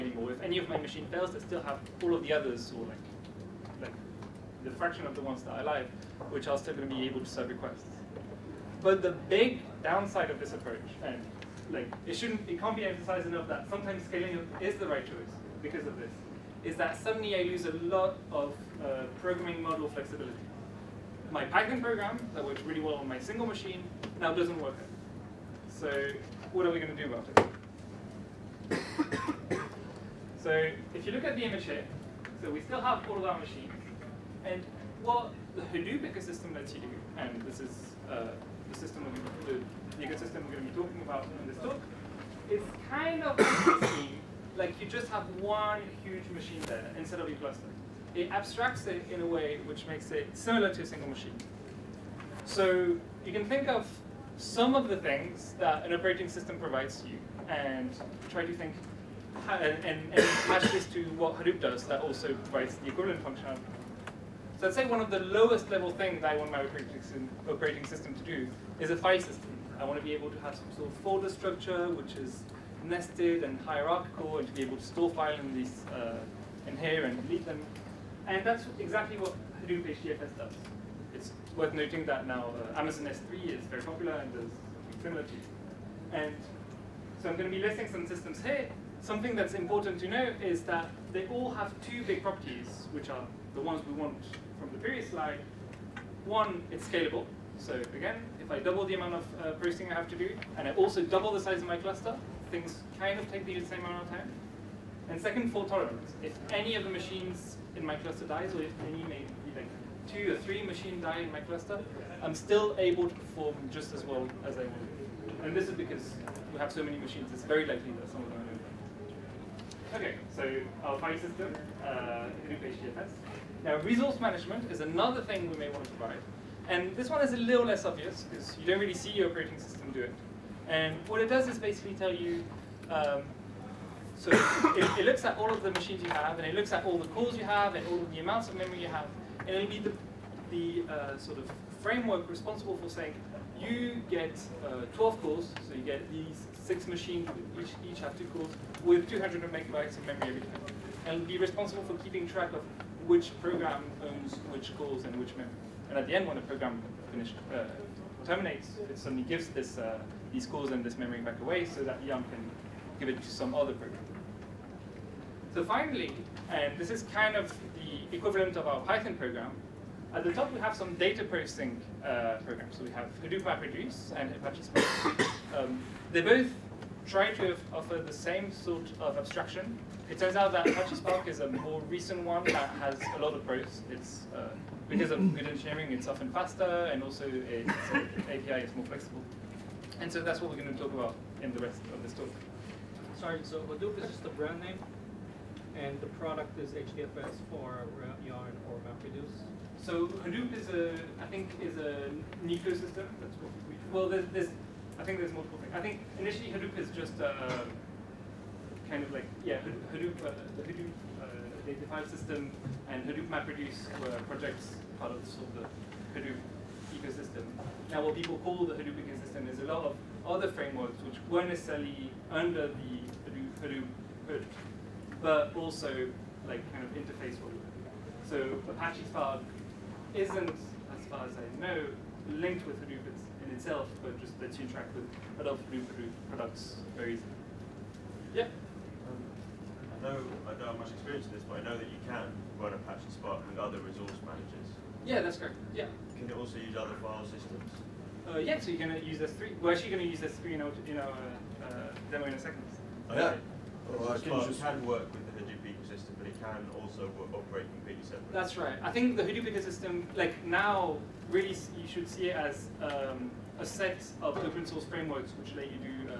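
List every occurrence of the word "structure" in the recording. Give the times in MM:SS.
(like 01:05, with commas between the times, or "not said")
01:11.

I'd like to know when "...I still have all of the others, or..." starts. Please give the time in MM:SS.
00:01.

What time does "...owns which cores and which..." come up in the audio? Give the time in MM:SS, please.
02:34.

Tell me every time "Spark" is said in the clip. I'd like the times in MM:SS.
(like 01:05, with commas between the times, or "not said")
02:54, 03:00, 03:49, 04:03.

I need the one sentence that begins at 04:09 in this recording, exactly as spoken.
We're actually going to use S3 in our, in our uh, demo in a second.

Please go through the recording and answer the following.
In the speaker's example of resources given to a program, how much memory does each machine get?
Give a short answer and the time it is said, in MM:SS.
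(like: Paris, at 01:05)
200 megabytes, at 02:29.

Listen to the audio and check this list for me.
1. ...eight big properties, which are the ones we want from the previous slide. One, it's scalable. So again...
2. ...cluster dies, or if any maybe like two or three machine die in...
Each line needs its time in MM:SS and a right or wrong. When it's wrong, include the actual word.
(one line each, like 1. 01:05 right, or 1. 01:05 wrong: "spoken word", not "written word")
1. 01:31 wrong: "two", not "eight"
2. 01:47 right.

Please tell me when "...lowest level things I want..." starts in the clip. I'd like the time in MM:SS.
01:05.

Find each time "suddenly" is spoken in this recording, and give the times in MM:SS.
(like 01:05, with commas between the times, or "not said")
00:16, 02:38.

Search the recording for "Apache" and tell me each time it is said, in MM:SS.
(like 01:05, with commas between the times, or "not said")
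02:54, 03:00, 03:48, 04:02.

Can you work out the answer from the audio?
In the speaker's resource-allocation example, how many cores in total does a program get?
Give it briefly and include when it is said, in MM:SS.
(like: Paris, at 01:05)
12, at 02:24.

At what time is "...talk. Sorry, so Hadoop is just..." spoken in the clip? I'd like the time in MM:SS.
03:12.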